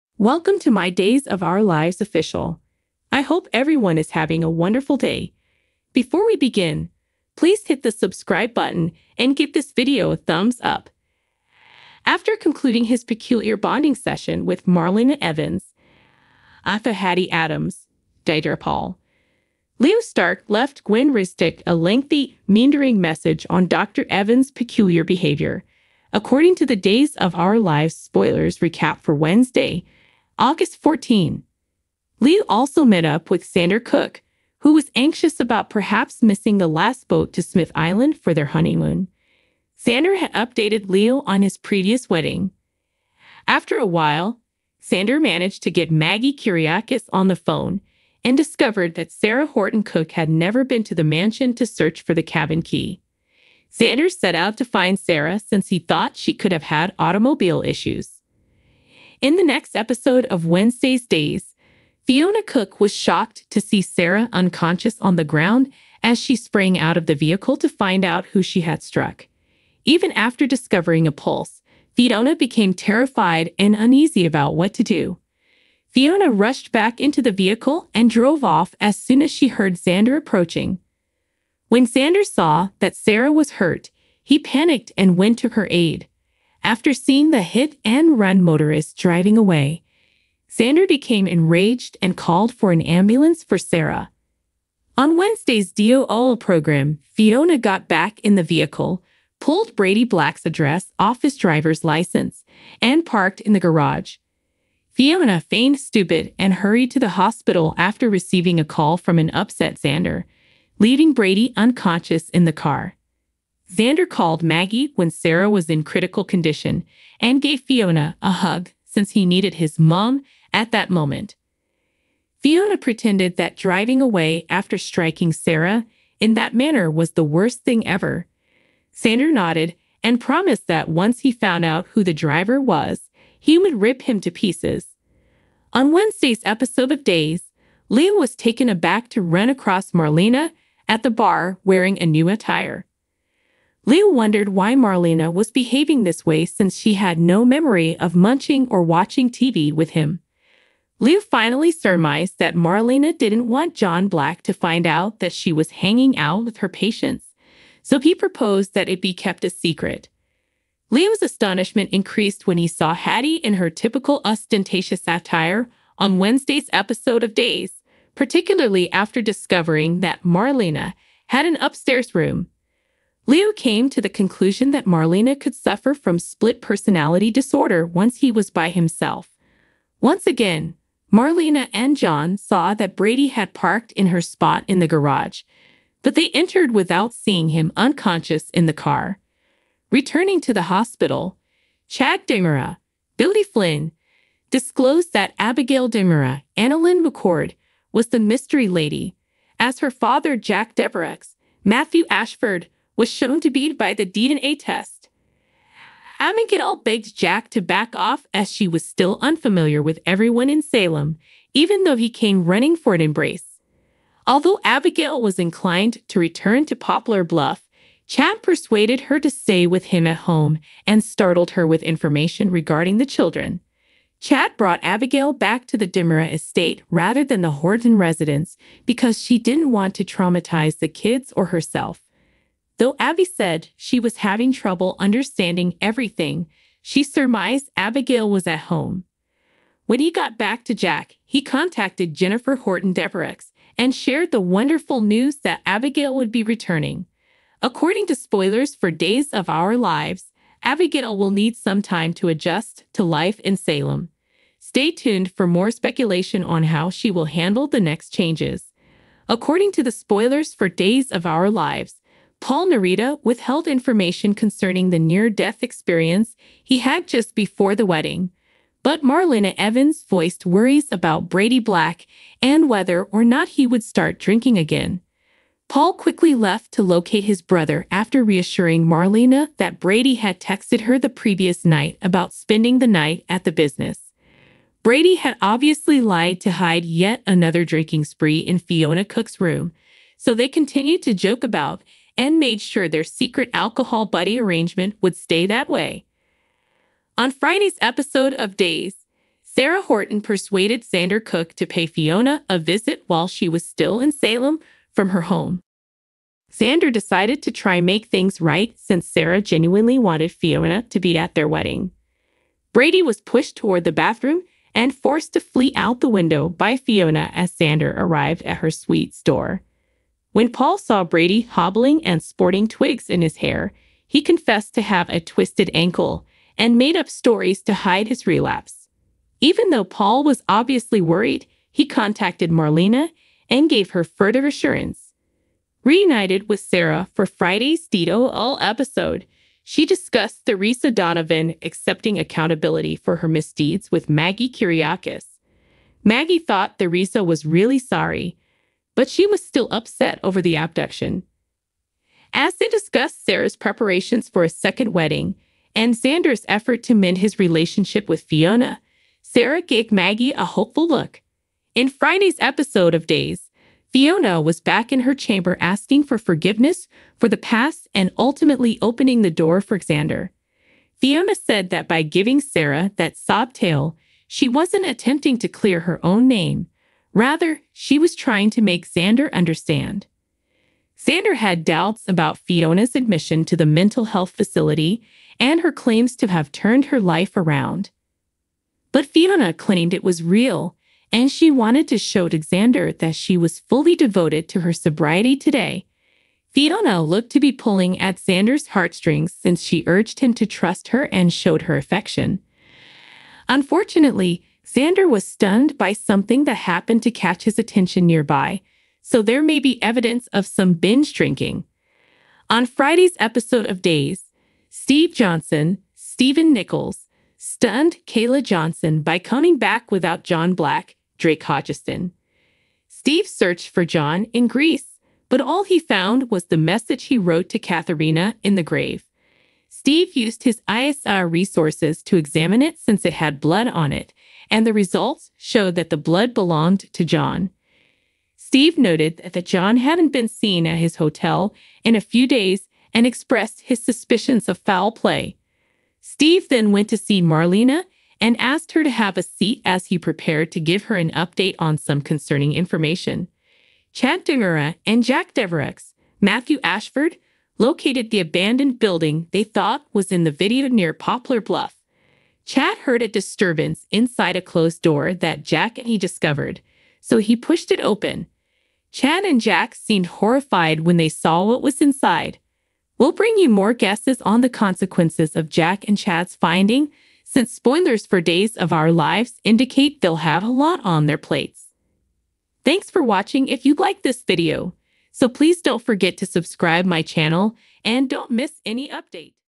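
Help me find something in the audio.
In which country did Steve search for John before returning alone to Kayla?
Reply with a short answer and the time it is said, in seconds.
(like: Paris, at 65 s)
Greece, at 424 s.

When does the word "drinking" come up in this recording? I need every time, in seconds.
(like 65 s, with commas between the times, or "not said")
274 s, 287 s, 411 s.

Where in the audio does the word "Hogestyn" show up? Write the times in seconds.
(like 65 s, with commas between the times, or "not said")
421 s.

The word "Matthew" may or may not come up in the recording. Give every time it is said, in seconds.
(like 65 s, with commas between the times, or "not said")
201 s, 456 s.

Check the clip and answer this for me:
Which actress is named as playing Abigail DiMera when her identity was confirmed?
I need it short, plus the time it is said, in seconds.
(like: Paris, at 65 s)
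AnnaLynne McCord, at 196 s.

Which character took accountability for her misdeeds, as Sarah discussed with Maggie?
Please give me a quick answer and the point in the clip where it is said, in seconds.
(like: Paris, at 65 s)
Theresa Donovan, at 340 s.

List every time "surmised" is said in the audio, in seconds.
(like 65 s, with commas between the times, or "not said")
151 s, 237 s.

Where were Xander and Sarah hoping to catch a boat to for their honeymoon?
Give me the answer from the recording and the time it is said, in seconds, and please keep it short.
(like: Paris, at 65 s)
Smith Island, at 37 s.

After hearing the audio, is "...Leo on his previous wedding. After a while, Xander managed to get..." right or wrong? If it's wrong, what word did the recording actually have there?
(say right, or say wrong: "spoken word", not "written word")
right.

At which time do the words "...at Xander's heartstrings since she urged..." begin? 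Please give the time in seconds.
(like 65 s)
397 s.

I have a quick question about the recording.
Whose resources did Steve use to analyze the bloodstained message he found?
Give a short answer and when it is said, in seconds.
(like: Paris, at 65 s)
ISR resources, at 430 s.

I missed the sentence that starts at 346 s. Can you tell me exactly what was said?
Maggie thought Theresa was really sorry but she was still upset over the abduction.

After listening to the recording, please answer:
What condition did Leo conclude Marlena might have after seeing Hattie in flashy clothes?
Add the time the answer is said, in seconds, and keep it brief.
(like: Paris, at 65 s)
Split personality disorder, at 176 s.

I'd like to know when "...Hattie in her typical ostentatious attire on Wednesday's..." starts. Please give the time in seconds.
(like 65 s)
162 s.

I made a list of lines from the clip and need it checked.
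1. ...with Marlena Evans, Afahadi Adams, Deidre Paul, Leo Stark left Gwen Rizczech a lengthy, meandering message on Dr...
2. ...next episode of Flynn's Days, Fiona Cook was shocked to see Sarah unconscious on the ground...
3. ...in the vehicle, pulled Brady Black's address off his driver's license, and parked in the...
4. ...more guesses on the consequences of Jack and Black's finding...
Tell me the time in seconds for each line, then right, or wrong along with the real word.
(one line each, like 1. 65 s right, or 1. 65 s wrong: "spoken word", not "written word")
1. 14 s right
2. 59 s wrong: "Wednesday", not "Flynn"
3. 98 s right
4. 473 s wrong: "Chad", not "Black".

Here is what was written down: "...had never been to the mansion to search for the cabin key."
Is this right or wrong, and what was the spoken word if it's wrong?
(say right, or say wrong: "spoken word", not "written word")
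right.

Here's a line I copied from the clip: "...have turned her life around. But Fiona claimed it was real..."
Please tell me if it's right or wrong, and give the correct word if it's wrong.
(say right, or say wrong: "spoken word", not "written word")
right.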